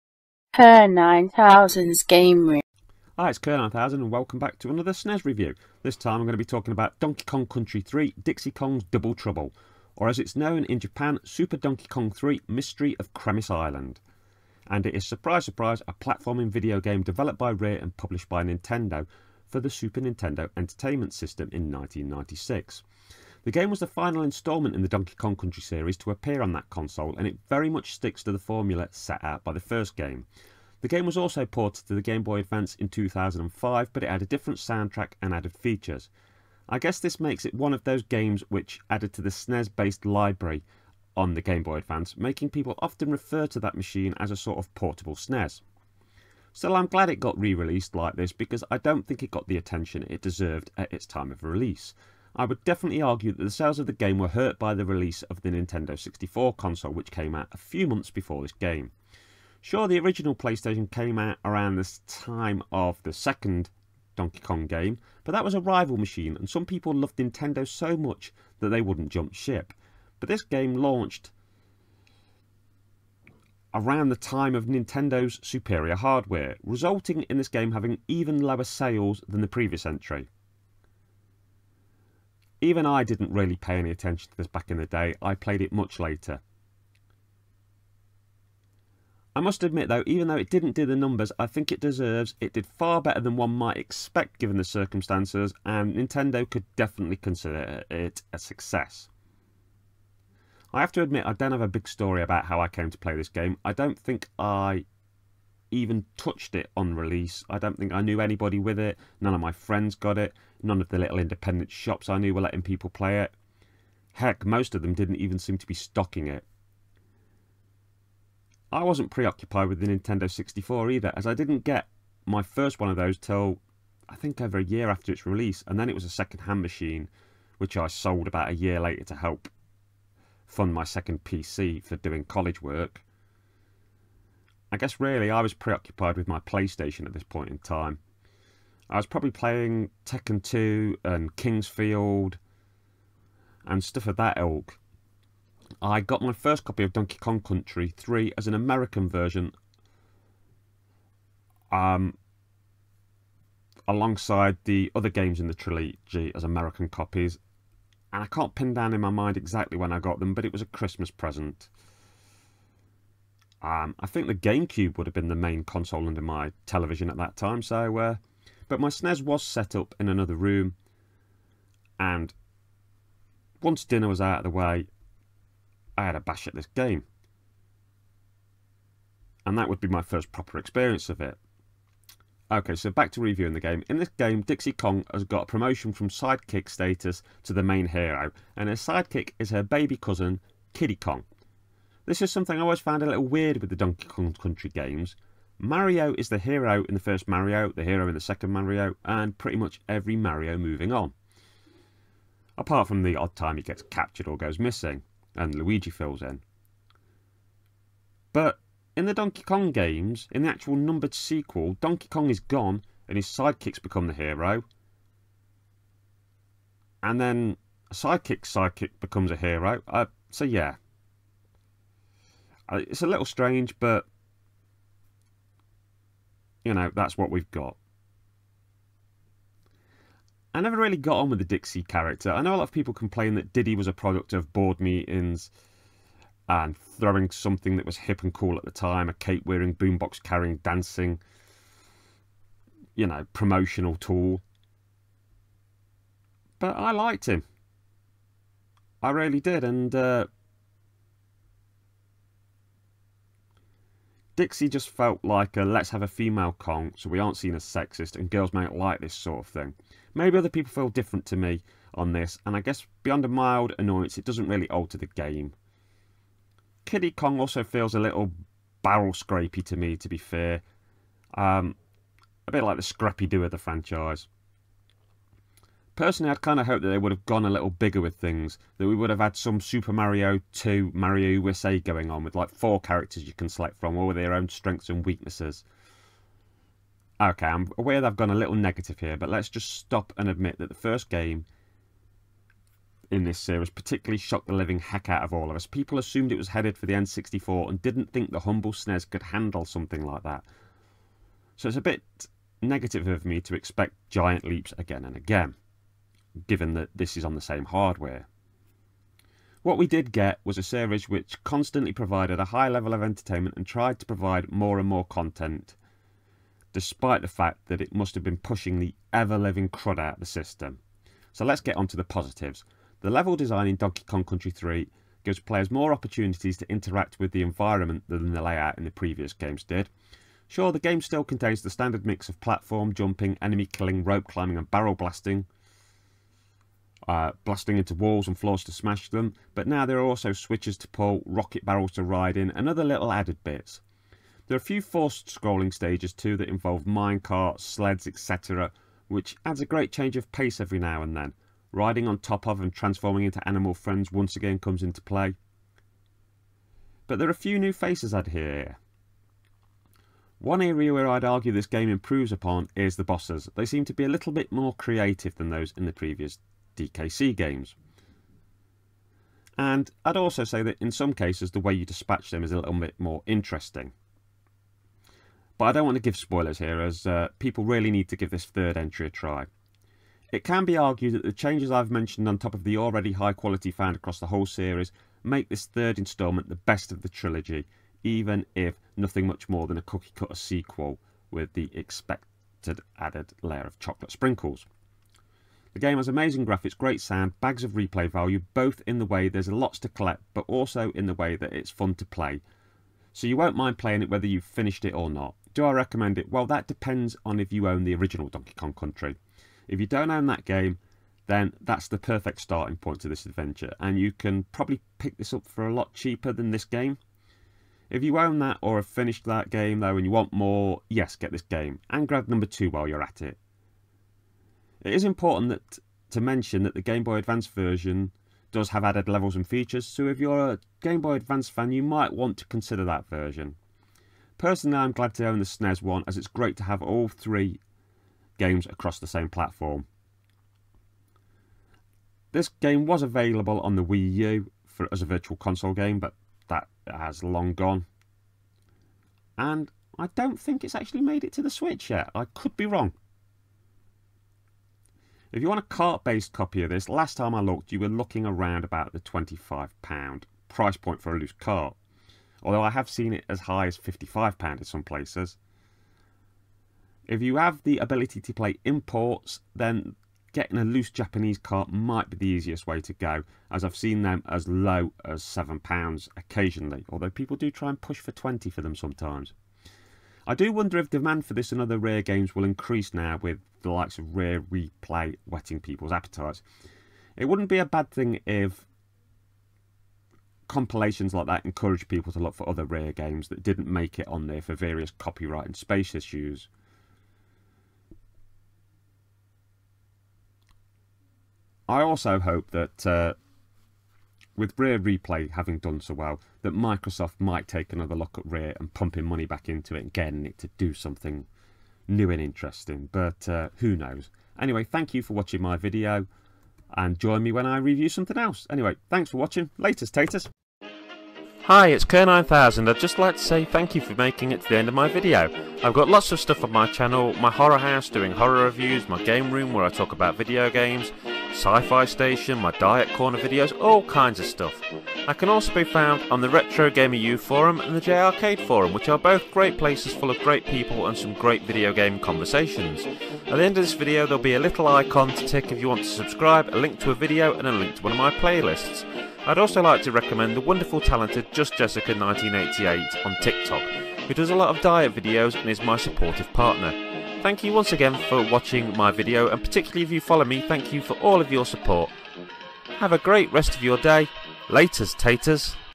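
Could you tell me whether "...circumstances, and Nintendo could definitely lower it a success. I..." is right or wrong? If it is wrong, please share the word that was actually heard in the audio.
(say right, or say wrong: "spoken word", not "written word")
wrong: "consider", not "lower".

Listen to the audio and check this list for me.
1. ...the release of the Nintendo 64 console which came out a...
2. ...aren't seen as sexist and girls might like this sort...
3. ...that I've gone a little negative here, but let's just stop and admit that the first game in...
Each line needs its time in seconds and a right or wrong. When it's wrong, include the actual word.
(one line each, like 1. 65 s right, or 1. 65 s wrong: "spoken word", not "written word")
1. 54 s right
2. 257 s right
3. 288 s right.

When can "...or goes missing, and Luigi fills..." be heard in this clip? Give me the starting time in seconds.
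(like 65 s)
204 s.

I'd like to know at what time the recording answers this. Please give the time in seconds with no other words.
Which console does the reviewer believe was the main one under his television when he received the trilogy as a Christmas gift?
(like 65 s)
164 s.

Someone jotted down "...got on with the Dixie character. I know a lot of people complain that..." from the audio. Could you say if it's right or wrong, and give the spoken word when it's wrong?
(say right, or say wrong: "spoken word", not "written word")
right.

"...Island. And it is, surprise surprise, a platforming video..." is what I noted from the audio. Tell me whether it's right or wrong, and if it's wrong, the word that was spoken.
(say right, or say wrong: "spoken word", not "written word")
right.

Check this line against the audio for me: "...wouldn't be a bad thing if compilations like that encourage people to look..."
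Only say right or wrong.
right.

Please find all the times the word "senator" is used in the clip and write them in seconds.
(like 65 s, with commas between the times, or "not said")
not said.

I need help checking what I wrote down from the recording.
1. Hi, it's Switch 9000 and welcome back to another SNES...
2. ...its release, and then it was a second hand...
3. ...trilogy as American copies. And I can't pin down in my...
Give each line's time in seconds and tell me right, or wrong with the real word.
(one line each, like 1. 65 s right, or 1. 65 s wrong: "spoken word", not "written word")
1. 3 s wrong: "Kerr", not "Switch"
2. 125 s right
3. 155 s right.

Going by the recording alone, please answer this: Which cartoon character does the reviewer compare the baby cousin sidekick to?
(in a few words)
Scrappy-Doo.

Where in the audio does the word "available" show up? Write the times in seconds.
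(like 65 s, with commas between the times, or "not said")
443 s.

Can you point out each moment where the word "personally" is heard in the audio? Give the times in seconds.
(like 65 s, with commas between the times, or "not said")
275 s, 434 s.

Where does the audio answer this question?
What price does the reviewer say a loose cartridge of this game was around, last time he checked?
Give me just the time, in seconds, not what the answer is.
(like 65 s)
458 s.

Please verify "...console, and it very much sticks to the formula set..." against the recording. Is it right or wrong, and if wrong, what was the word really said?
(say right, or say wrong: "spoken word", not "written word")
right.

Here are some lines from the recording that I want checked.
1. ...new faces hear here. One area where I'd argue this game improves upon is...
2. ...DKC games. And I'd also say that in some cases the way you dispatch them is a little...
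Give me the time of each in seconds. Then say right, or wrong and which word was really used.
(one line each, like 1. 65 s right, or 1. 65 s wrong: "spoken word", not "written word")
1. 357 s right
2. 366 s right.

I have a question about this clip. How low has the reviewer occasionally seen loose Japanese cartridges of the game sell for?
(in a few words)
£7.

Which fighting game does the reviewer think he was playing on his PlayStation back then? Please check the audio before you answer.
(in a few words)
Tekken 2.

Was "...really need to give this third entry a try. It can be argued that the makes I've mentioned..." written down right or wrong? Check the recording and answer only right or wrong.
wrong.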